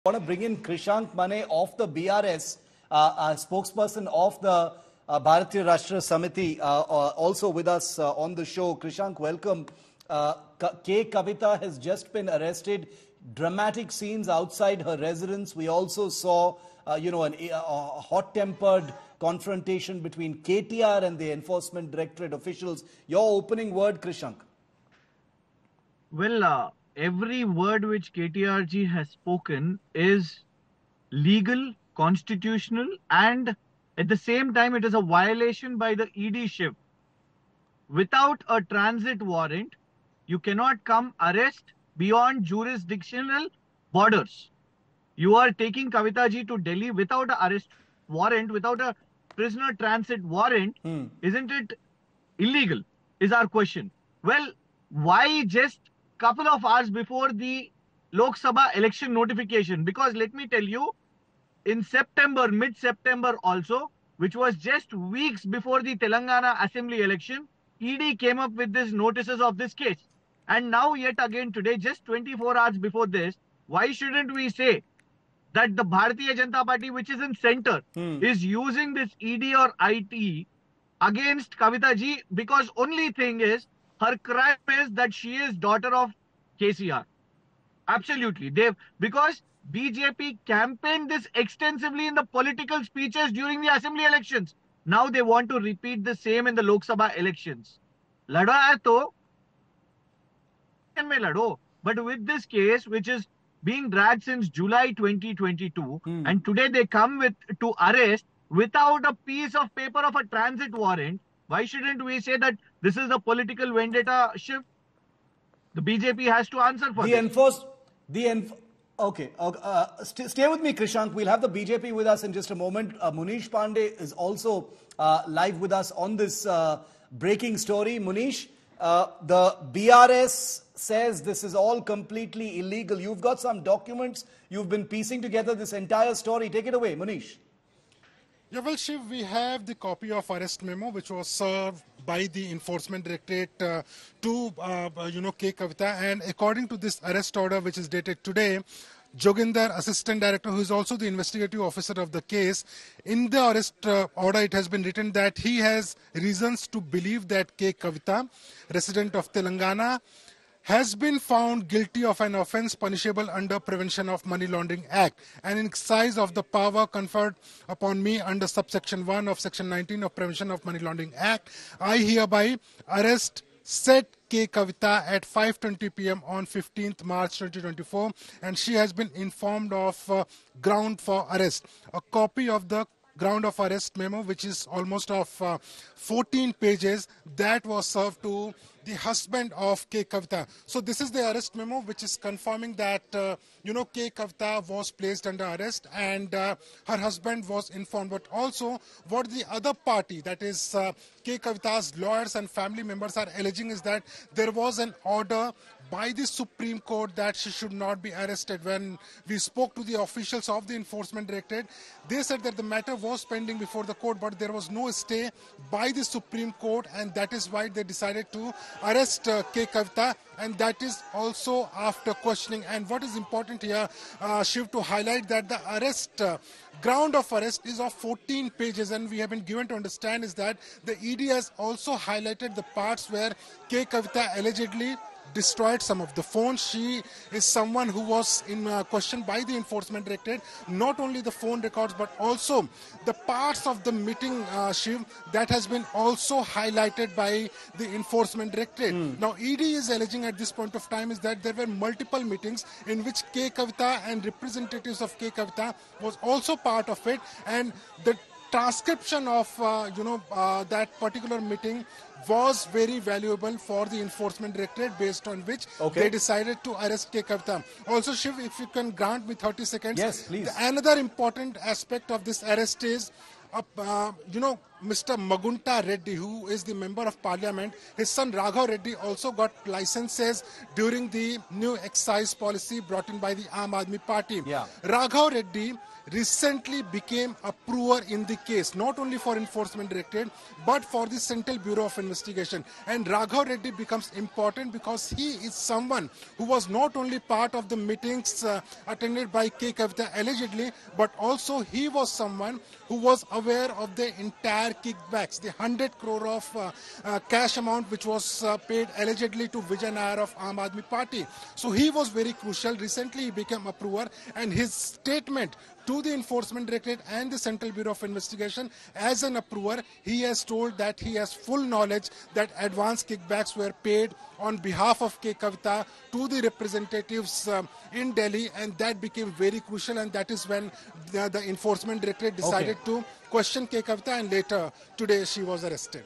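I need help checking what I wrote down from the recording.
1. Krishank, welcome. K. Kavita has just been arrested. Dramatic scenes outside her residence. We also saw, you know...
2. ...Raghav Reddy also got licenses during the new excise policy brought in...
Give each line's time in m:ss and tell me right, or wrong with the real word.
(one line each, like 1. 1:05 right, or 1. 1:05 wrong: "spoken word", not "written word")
1. 0:08 right
2. 4:38 right.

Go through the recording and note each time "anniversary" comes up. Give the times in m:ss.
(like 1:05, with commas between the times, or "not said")
not said.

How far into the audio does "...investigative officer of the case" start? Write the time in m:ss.
2:31.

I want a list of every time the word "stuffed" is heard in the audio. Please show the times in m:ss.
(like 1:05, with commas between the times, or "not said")
not said.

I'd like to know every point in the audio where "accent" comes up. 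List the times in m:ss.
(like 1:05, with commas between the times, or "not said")
not said.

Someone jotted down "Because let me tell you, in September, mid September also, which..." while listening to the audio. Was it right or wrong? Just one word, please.
right.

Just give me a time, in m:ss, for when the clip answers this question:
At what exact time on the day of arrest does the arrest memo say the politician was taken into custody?
2:55.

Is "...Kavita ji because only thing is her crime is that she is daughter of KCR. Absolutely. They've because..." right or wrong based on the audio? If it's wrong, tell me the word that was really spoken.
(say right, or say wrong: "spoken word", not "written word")
right.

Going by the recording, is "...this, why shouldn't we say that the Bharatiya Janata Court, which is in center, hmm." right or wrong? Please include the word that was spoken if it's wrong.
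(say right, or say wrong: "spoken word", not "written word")
wrong: "Party", not "Court".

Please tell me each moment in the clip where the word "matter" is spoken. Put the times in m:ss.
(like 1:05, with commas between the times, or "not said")
3:32.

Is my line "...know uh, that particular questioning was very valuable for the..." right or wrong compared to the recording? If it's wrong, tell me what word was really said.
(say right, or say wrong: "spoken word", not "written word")
wrong: "meeting", not "questioning".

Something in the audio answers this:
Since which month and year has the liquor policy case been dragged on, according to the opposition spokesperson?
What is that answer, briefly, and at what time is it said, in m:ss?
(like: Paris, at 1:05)
July 2022, at 1:44.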